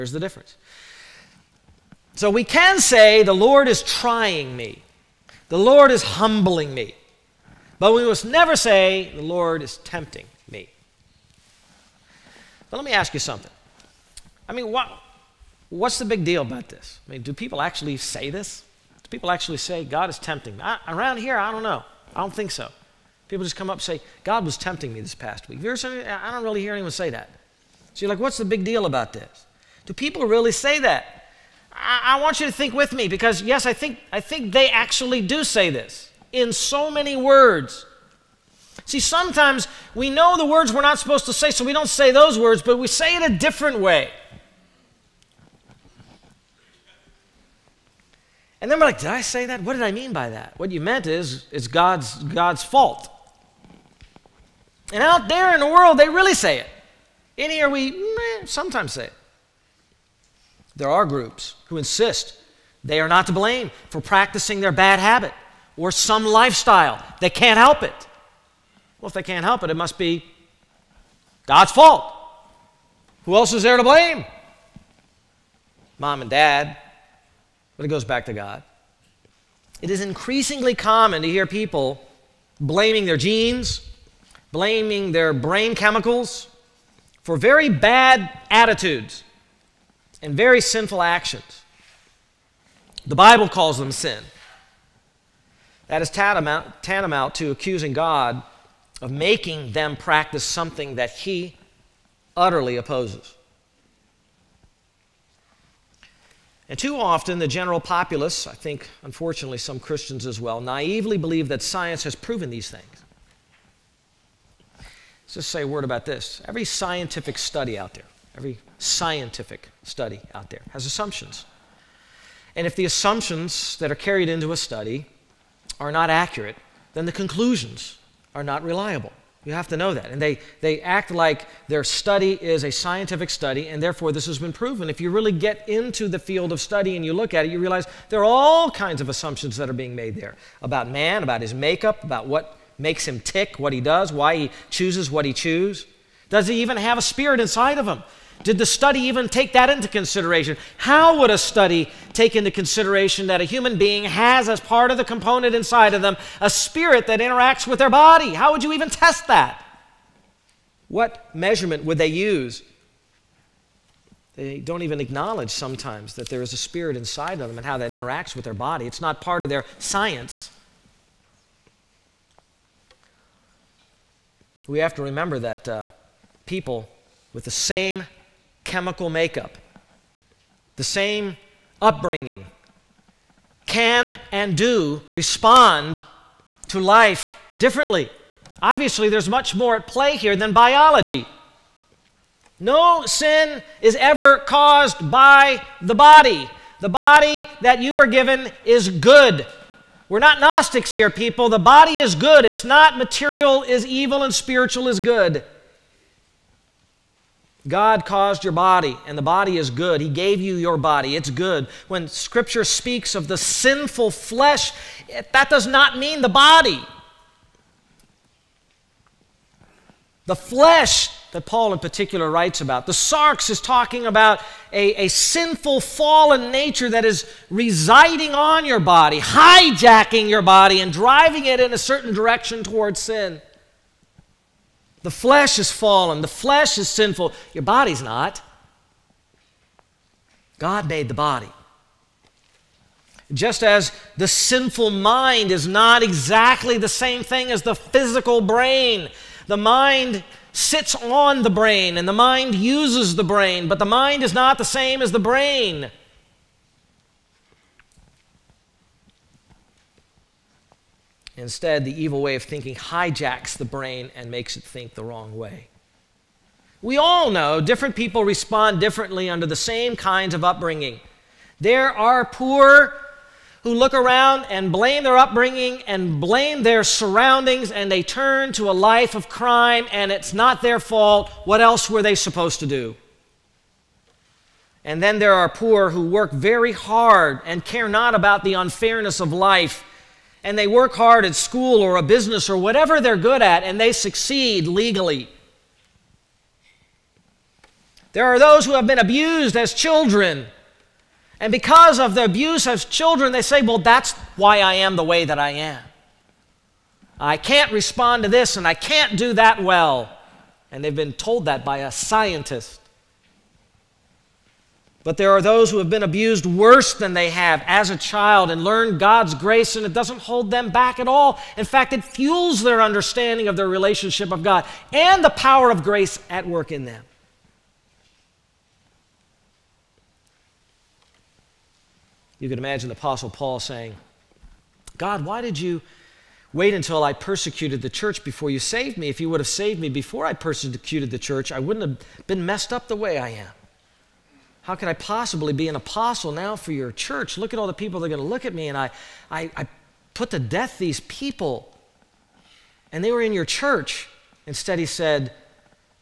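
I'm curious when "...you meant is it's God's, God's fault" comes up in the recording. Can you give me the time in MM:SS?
00:50.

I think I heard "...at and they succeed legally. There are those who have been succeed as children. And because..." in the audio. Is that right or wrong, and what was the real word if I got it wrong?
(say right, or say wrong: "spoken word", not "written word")
wrong: "abused", not "succeed".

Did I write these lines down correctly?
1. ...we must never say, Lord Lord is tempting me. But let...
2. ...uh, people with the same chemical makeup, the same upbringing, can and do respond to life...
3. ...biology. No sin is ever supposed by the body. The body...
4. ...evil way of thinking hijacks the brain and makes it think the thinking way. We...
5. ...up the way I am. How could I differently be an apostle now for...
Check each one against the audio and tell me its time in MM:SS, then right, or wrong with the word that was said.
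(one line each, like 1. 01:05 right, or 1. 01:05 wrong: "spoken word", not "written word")
1. 00:07 wrong: "The", not "Lord"
2. 02:55 right
3. 03:10 wrong: "caused", not "supposed"
4. 04:22 wrong: "wrong", not "thinking"
5. 05:42 wrong: "possibly", not "differently".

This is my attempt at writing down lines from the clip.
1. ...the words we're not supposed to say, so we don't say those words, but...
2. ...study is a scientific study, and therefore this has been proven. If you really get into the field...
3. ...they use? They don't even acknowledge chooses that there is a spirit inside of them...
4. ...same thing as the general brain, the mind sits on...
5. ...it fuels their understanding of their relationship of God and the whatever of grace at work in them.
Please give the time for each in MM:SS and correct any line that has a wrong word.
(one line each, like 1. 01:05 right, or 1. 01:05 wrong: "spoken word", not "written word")
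1. 00:40 right
2. 02:11 right
3. 02:41 wrong: "sometimes", not "chooses"
4. 04:06 wrong: "physical", not "general"
5. 05:21 wrong: "power", not "whatever".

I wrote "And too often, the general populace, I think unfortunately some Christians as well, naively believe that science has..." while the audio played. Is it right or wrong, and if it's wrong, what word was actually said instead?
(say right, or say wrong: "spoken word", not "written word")
right.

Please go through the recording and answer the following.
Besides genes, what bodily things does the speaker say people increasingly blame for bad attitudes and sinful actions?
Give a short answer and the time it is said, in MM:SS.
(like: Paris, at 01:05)
brain chemicals, at 01:25.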